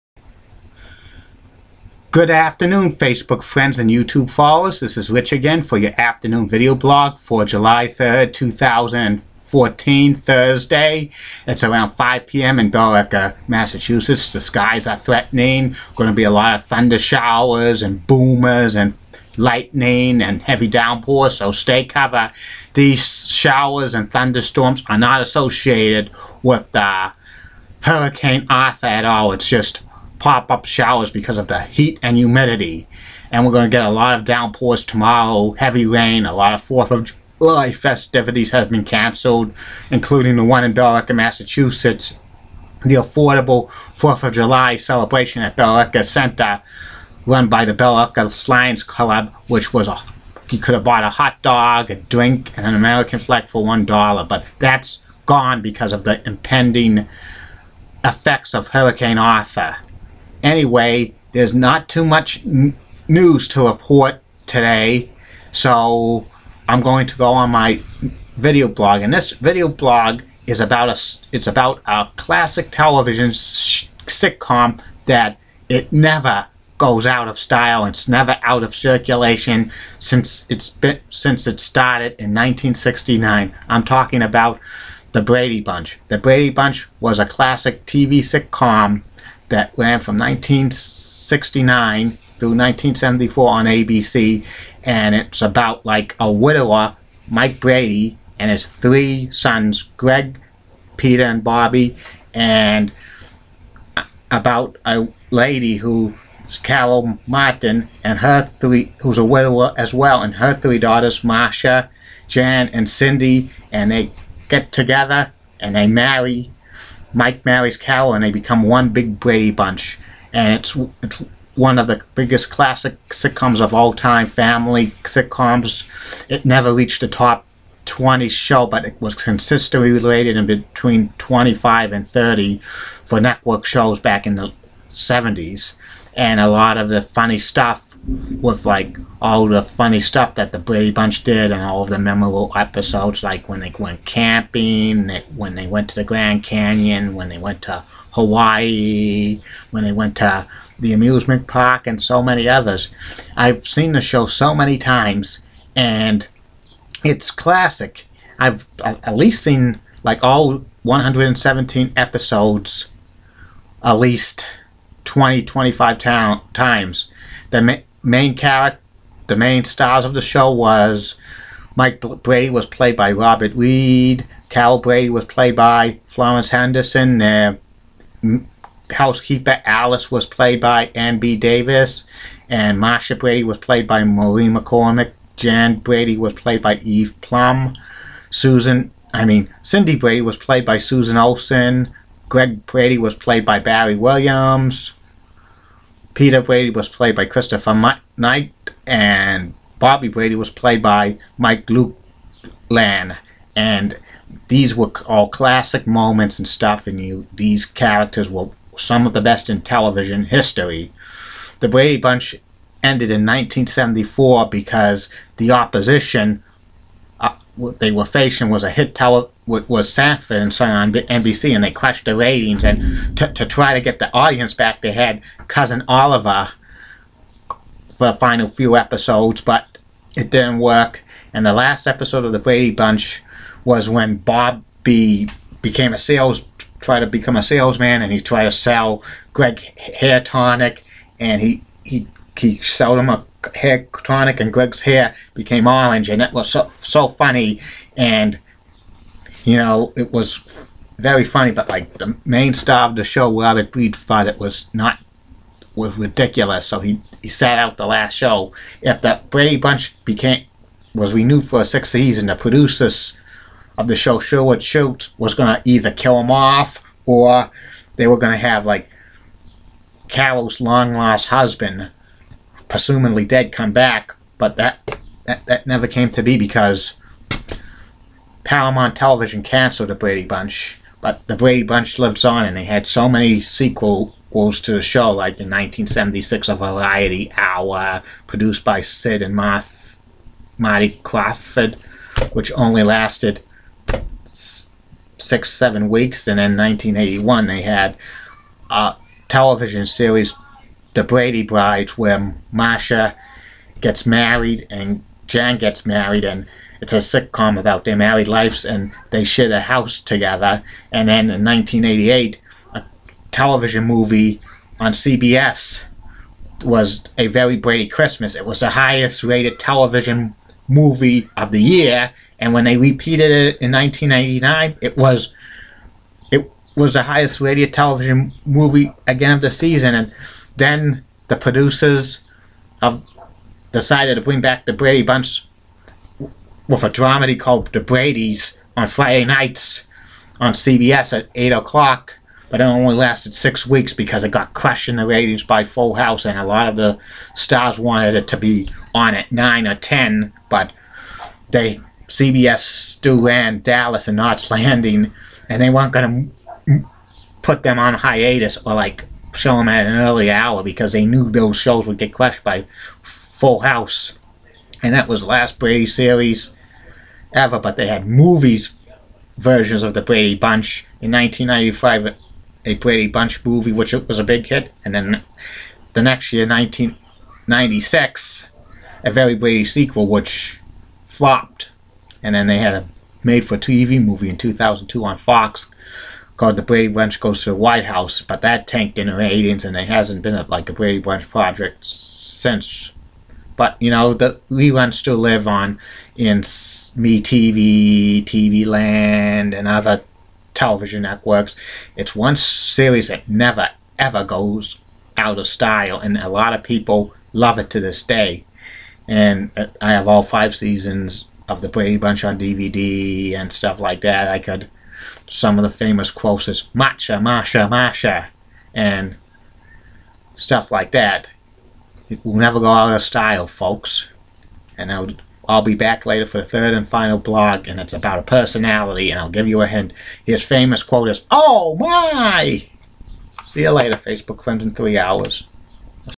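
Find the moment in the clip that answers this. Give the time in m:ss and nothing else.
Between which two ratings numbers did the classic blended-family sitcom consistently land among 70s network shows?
2:11.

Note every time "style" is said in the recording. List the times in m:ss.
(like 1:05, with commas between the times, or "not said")
1:17, 6:45, 7:03.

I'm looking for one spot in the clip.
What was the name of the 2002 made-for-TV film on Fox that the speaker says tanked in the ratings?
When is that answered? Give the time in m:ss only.
6:26.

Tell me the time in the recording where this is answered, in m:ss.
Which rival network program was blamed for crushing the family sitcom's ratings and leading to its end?
3:39.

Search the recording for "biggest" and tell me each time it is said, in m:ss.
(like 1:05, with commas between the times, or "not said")
2:02.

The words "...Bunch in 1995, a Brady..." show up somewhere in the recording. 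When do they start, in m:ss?
6:10.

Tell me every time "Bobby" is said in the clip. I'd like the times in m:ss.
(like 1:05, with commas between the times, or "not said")
1:41, 3:19.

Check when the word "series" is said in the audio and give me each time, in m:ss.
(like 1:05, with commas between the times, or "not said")
4:59, 6:05, 6:42.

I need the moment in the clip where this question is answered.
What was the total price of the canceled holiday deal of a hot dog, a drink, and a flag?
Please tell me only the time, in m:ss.
0:53.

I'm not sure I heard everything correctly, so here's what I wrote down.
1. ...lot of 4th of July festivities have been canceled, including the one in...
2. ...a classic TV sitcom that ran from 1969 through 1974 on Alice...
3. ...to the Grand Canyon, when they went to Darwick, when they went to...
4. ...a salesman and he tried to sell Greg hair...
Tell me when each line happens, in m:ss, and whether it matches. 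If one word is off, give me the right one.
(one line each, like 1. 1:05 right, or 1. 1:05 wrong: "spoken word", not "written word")
1. 0:36 right
2. 1:27 wrong: "ABC", not "Alice"
3. 2:25 wrong: "Hawaii", not "Darwick"
4. 3:57 right.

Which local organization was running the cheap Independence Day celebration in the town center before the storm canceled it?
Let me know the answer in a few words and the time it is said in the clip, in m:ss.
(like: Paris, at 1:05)
Billerica Lions Club, at 0:47.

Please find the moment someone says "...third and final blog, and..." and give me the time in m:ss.
7:06.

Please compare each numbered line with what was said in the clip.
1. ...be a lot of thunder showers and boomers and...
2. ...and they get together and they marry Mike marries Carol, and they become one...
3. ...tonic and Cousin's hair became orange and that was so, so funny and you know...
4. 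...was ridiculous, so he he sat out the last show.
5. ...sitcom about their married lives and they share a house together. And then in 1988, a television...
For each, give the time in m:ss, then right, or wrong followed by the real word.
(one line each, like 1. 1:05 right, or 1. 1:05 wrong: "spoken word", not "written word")
1. 0:16 right
2. 1:53 right
3. 4:04 wrong: "Greg", not "Cousin"
4. 4:15 right
5. 5:06 right.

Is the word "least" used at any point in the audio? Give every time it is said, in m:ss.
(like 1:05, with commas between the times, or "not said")
2:39, 2:43.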